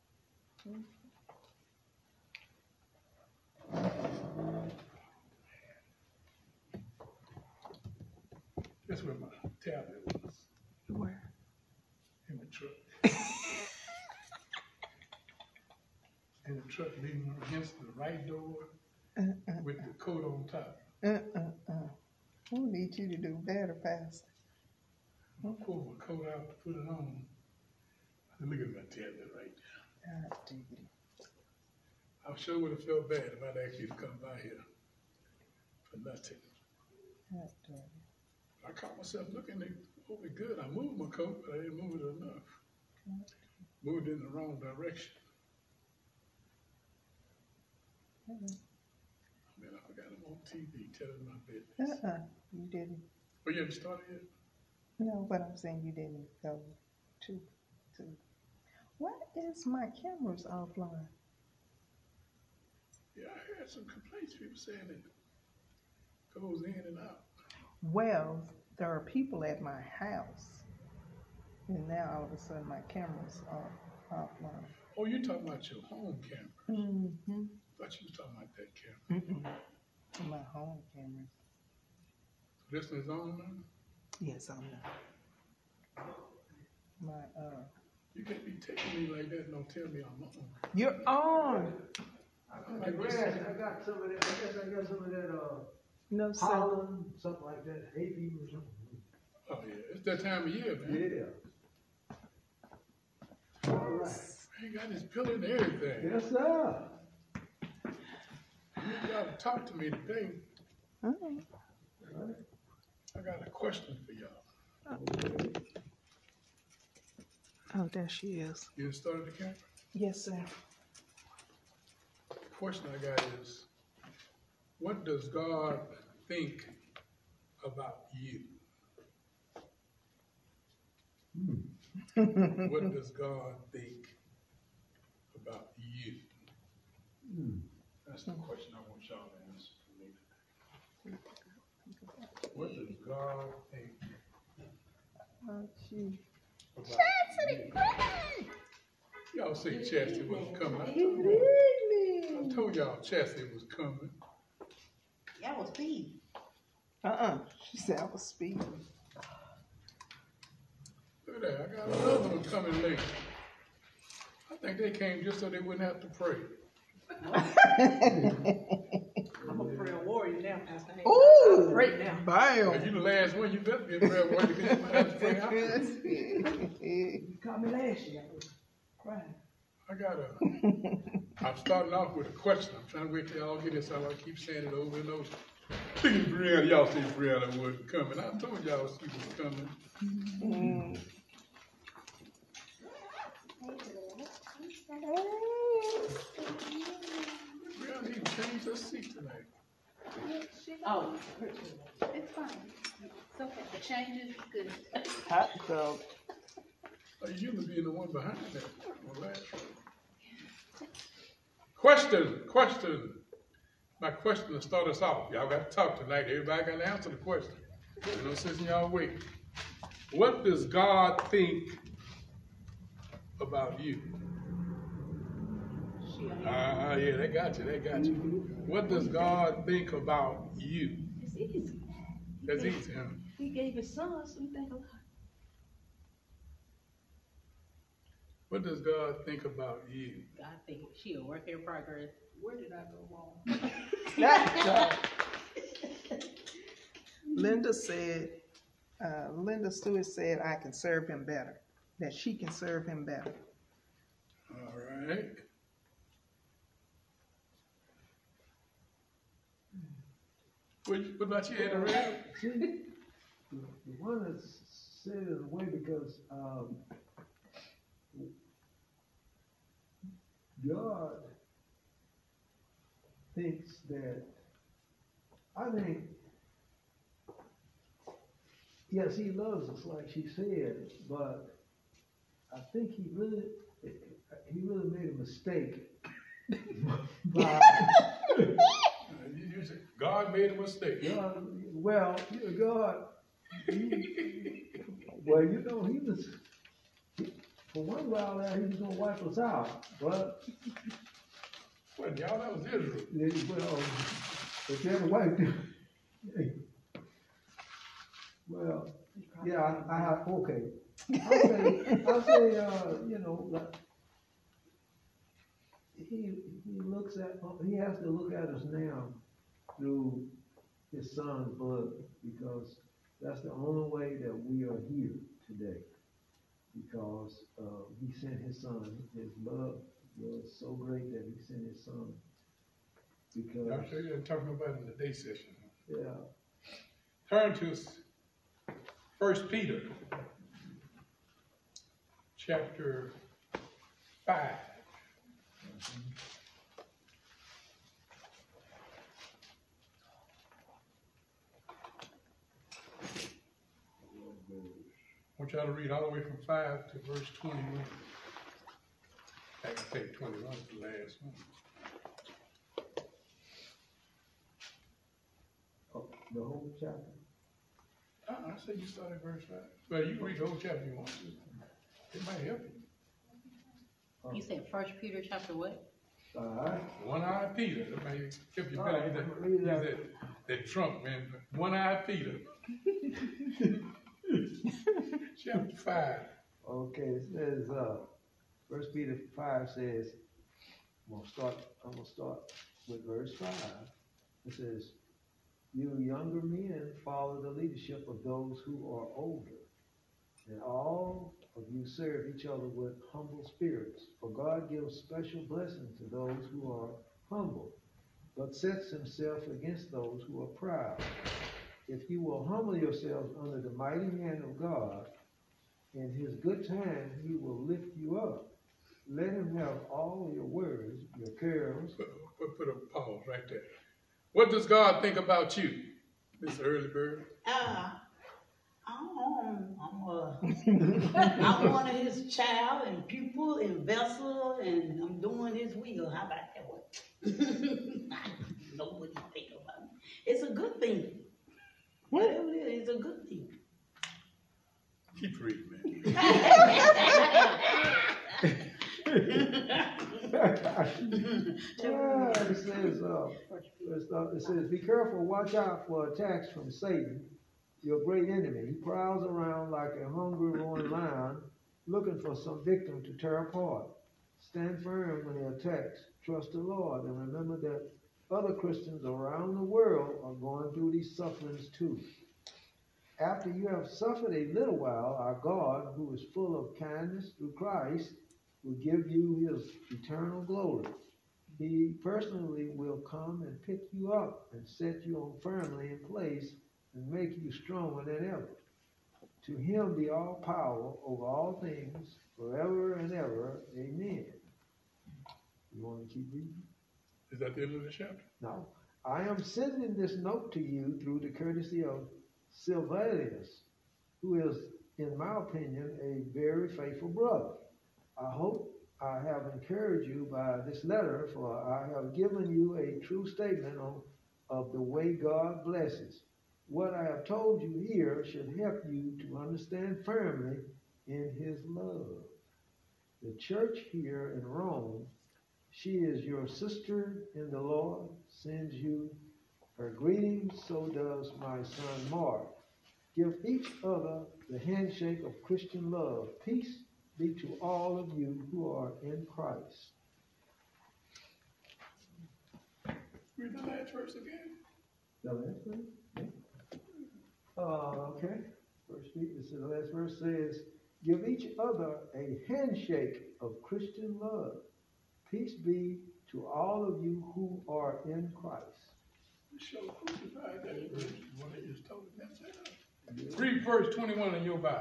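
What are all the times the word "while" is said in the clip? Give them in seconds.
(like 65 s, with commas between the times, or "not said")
298 s, 474 s.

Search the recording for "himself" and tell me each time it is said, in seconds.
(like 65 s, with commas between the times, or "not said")
408 s.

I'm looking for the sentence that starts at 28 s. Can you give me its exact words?
Look at my tether right now.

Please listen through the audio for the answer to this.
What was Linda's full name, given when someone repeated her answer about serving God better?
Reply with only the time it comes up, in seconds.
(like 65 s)
249 s.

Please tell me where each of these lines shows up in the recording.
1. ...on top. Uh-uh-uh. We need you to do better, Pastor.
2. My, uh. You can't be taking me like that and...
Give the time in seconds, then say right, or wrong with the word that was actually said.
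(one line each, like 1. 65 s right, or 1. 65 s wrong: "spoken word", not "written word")
1. 20 s right
2. 87 s right.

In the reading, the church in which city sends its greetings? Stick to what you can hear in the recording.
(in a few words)
Rome.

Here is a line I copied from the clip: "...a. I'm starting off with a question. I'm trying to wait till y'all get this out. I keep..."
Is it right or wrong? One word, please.
right.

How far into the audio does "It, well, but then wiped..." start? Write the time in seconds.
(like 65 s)
303 s.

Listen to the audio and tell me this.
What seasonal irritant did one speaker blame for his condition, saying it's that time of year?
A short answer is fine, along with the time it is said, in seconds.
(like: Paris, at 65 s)
Hay, at 97 s.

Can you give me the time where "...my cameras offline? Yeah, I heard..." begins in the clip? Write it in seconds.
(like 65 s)
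59 s.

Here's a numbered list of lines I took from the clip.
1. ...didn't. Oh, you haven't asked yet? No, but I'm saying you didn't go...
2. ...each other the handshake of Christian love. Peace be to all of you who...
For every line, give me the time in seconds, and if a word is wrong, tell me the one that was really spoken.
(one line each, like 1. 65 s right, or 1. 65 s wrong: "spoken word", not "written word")
1. 52 s wrong: "started", not "asked"
2. 533 s right.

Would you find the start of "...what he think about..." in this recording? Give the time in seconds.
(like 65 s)
438 s.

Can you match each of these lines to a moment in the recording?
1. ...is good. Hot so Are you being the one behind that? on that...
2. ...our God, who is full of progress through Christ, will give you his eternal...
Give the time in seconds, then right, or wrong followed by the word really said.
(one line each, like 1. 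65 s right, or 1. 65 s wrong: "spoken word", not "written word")
1. 204 s right
2. 475 s wrong: "kindness", not "progress".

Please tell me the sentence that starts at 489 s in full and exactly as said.
To him be all power over all things forever and ever.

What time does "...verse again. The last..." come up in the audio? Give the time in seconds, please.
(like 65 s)
543 s.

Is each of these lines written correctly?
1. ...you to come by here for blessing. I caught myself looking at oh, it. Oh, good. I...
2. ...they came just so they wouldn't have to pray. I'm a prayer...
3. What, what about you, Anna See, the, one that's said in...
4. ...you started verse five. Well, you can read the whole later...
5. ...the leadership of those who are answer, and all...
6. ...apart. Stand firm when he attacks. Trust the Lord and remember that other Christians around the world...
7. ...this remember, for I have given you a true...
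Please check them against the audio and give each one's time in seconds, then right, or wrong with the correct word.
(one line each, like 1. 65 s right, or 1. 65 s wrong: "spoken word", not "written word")
1. 33 s wrong: "nothing", not "blessing"
2. 164 s right
3. 260 s right
4. 368 s wrong: "chapter", not "later"
5. 397 s wrong: "older", not "answer"
6. 463 s right
7. 510 s wrong: "letter", not "remember".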